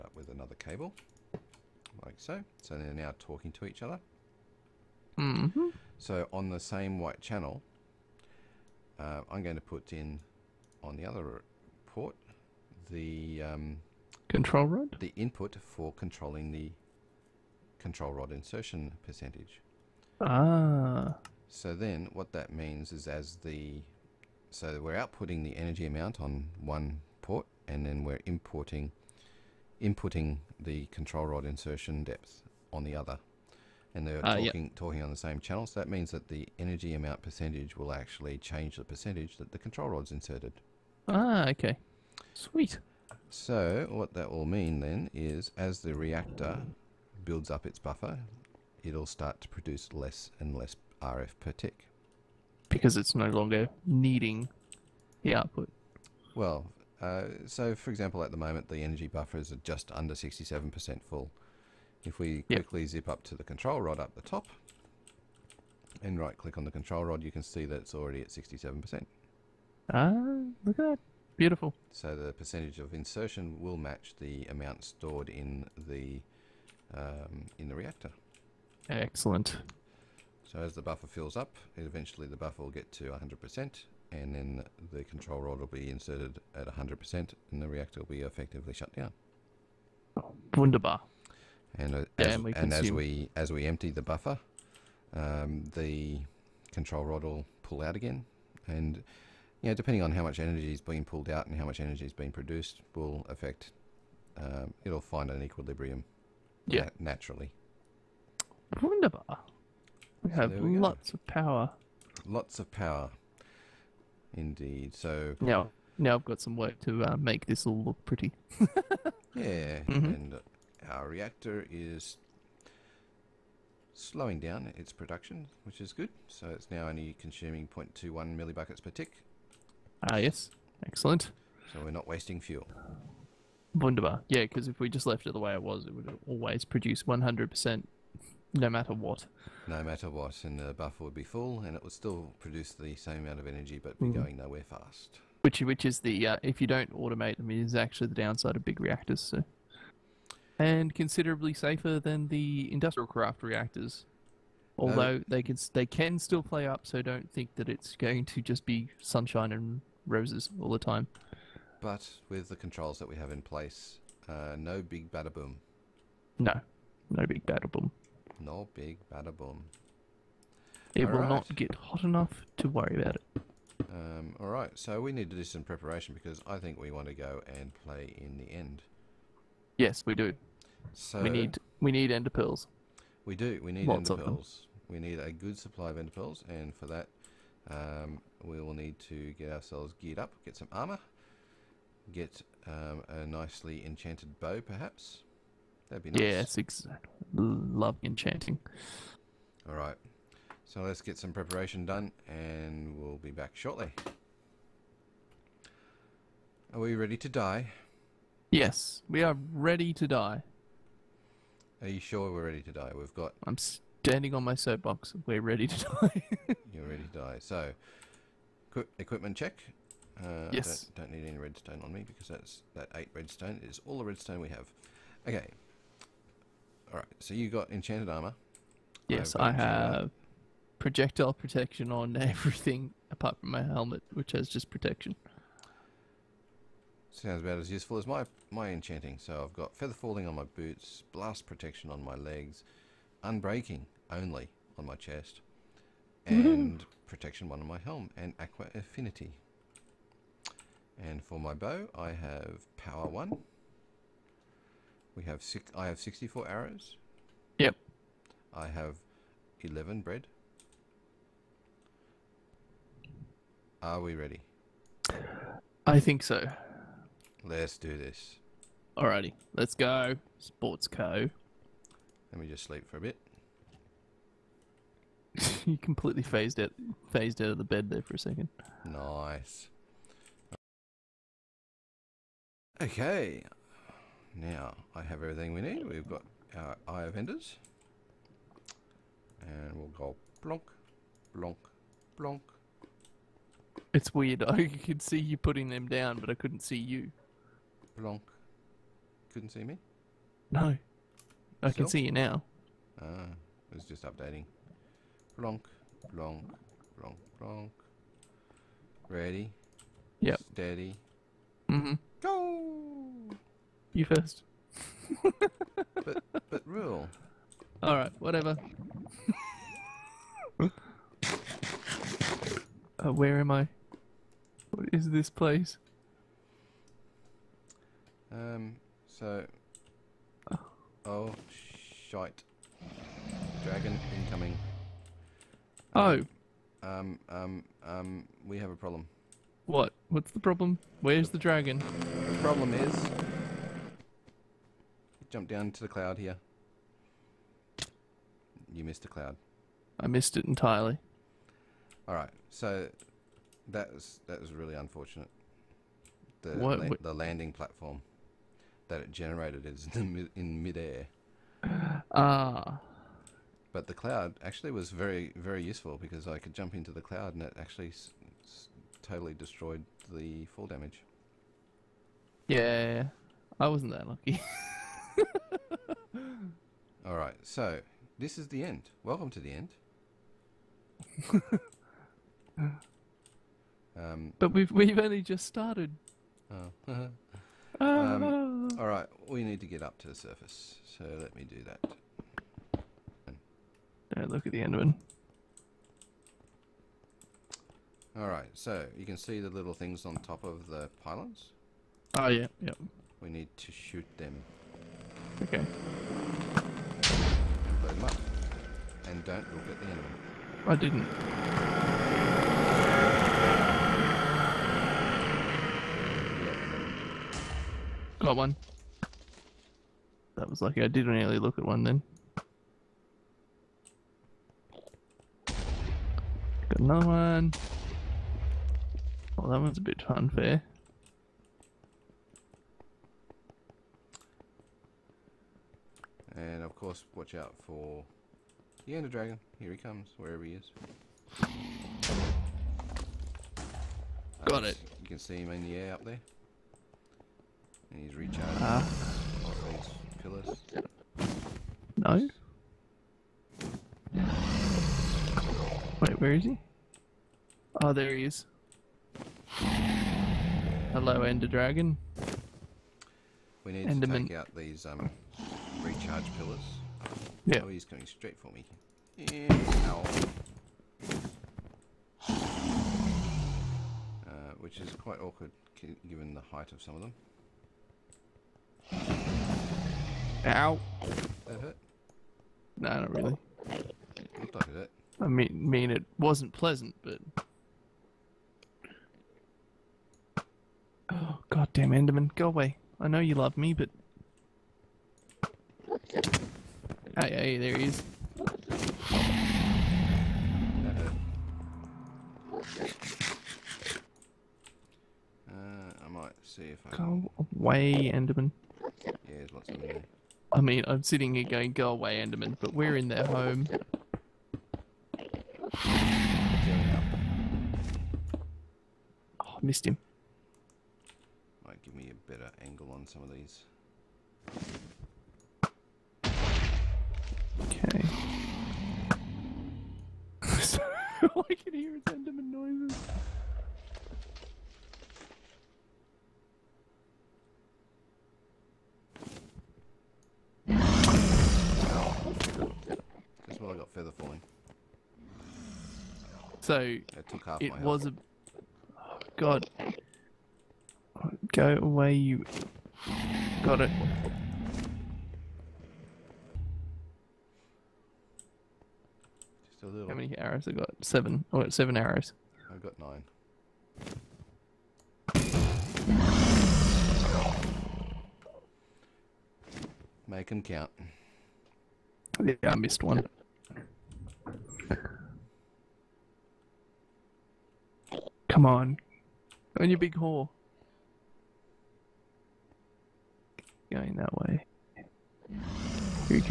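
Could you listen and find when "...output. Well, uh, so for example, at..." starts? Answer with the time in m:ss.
0:55.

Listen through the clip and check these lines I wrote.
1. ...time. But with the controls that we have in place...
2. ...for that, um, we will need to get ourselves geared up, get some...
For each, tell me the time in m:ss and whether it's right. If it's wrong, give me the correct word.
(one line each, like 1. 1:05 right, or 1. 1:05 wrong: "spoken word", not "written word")
1. 2:40 right
2. 3:06 right.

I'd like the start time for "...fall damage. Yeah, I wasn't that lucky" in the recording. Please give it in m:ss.
6:10.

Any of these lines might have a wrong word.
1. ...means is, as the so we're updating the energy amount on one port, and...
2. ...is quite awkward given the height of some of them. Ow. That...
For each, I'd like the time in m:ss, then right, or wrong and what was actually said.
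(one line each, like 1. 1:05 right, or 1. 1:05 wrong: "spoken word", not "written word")
1. 0:22 wrong: "outputting", not "updating"
2. 7:54 right.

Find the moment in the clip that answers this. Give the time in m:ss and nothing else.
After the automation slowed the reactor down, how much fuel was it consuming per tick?
2:07.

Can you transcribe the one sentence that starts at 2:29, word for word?
So and considerably safer than the industrial craft reactors.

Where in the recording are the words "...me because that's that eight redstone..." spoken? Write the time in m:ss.
3:41.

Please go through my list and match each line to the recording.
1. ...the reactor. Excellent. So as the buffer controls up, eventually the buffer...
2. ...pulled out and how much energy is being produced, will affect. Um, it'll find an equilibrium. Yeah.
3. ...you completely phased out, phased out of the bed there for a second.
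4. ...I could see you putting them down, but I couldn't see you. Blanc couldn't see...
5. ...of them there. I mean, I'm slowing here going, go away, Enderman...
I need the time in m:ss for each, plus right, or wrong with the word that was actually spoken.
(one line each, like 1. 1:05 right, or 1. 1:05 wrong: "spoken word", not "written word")
1. 1:17 wrong: "fills", not "controls"
2. 1:41 right
3. 4:35 right
4. 4:54 right
5. 8:29 wrong: "sitting", not "slowing".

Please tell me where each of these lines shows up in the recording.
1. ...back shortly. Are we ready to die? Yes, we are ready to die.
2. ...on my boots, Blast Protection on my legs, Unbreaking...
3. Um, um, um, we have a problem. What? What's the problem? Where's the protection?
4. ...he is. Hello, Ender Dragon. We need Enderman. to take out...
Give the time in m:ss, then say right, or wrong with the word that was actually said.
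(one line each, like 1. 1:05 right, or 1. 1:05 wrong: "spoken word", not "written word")
1. 3:23 right
2. 4:00 right
3. 5:36 wrong: "dragon", not "protection"
4. 7:38 right.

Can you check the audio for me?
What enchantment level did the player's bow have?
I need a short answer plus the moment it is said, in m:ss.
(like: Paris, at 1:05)
Power 1, at 4:12.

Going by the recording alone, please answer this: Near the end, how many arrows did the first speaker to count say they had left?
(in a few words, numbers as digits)
7.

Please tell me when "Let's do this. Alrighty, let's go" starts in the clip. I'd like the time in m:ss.
4:27.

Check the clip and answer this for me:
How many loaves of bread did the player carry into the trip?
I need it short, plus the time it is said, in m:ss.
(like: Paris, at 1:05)
11, at 4:19.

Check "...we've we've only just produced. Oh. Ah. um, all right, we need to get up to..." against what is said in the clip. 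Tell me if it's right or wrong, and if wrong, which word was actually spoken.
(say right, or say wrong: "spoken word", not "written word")
wrong: "started", not "produced".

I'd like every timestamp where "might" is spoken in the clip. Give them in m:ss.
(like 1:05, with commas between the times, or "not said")
8:26, 8:41.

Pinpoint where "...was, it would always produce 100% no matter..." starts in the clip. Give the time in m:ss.
2:15.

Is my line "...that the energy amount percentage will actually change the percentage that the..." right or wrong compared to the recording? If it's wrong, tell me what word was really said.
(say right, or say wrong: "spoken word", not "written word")
right.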